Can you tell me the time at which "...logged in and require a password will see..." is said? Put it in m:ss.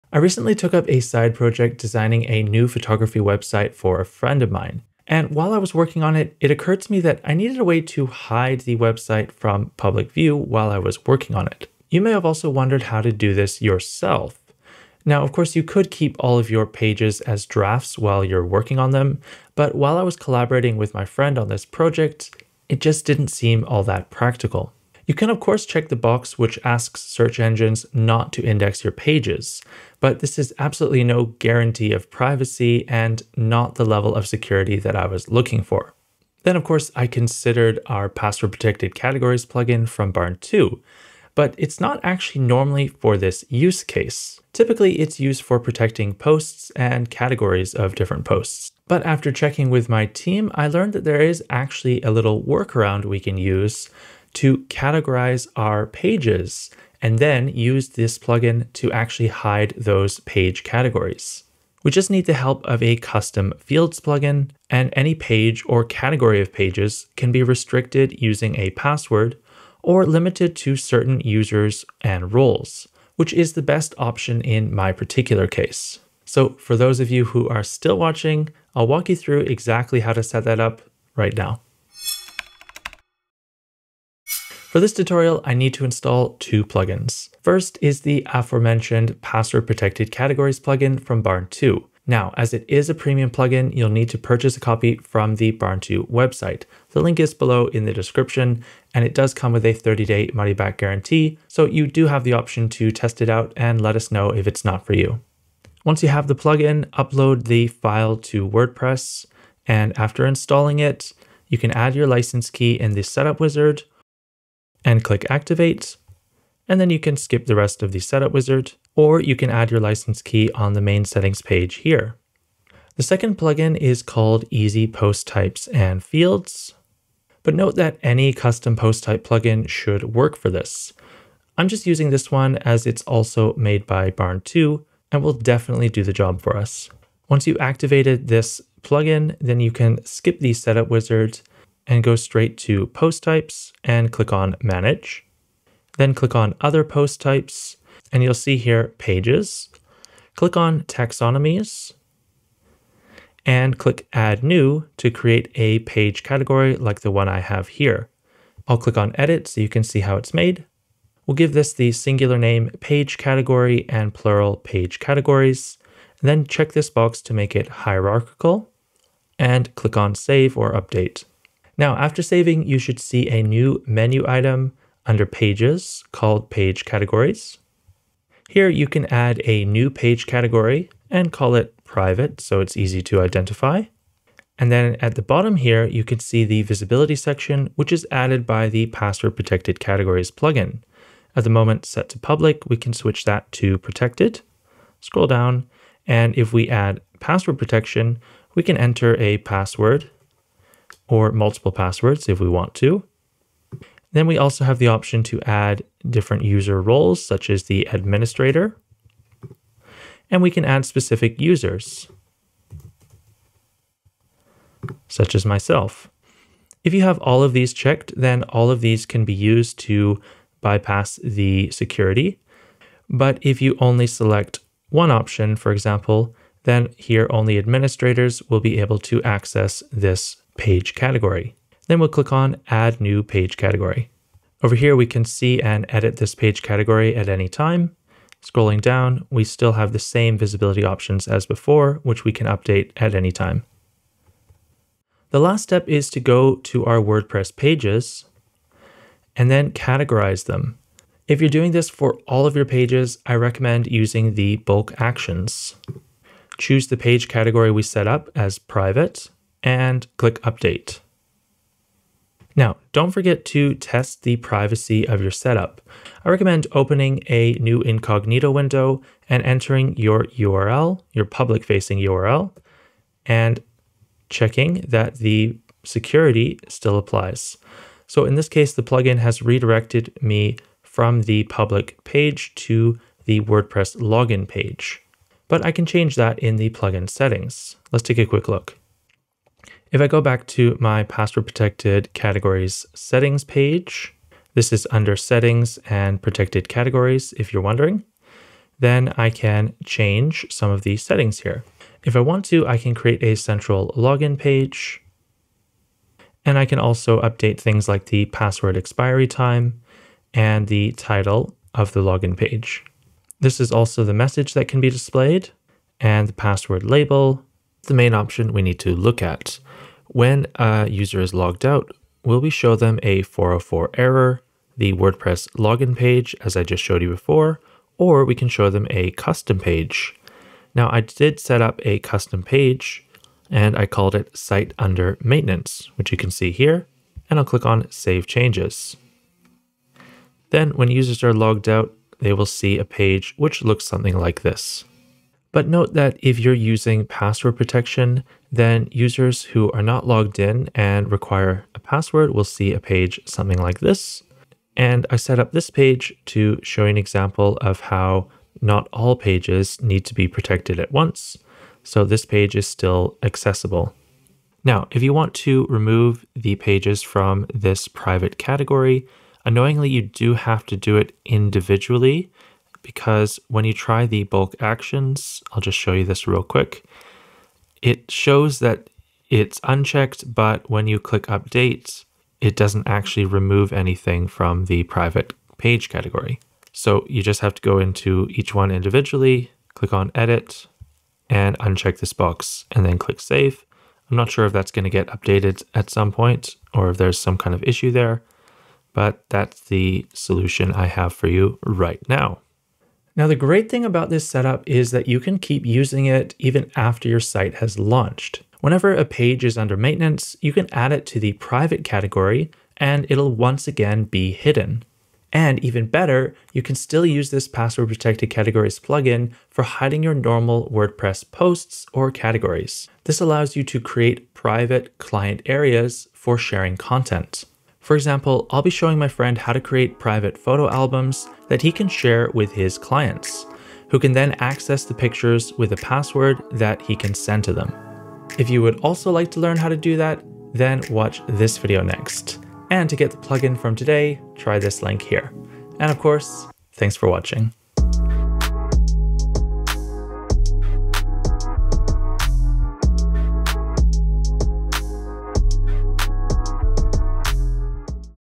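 5:50.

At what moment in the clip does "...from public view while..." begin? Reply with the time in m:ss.
0:09.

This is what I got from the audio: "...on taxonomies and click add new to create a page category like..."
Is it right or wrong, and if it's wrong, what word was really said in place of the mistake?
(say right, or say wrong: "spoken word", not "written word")
right.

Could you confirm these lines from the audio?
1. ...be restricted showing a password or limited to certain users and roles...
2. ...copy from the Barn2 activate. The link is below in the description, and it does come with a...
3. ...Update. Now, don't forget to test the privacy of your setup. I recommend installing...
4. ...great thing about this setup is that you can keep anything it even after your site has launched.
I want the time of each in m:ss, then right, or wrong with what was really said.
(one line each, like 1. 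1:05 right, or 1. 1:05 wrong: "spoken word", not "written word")
1. 1:07 wrong: "using", not "showing"
2. 1:34 wrong: "website", not "activate"
3. 4:20 wrong: "opening", not "installing"
4. 6:43 wrong: "using", not "anything".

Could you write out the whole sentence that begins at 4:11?
If you're doing this for all of your pages, I recommend using the bulk actions.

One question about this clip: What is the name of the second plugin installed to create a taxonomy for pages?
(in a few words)
Easy Post Types and Fields.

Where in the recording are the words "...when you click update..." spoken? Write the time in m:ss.
6:20.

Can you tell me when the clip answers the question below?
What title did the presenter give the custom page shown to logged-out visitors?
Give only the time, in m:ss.
5:34.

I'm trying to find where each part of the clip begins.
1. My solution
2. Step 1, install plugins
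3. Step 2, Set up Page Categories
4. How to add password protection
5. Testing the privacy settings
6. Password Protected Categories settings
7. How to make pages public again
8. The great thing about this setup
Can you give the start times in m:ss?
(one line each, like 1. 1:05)
1. 0:37
2. 1:22
3. 2:20
4. 3:04
5. 4:22
6. 4:50
7. 6:04
8. 6:42.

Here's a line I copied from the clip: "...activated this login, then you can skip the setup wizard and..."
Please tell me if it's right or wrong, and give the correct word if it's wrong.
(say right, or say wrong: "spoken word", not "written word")
wrong: "plugin", not "login".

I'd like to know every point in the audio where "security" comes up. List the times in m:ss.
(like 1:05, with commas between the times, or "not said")
0:34, 3:41, 4:35.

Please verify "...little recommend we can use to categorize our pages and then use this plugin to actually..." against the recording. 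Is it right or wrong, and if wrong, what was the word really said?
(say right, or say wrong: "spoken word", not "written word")
wrong: "workaround", not "recommend".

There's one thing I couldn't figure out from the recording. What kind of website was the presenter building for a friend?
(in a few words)
photography website.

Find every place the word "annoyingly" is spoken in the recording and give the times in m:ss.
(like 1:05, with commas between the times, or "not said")
6:09.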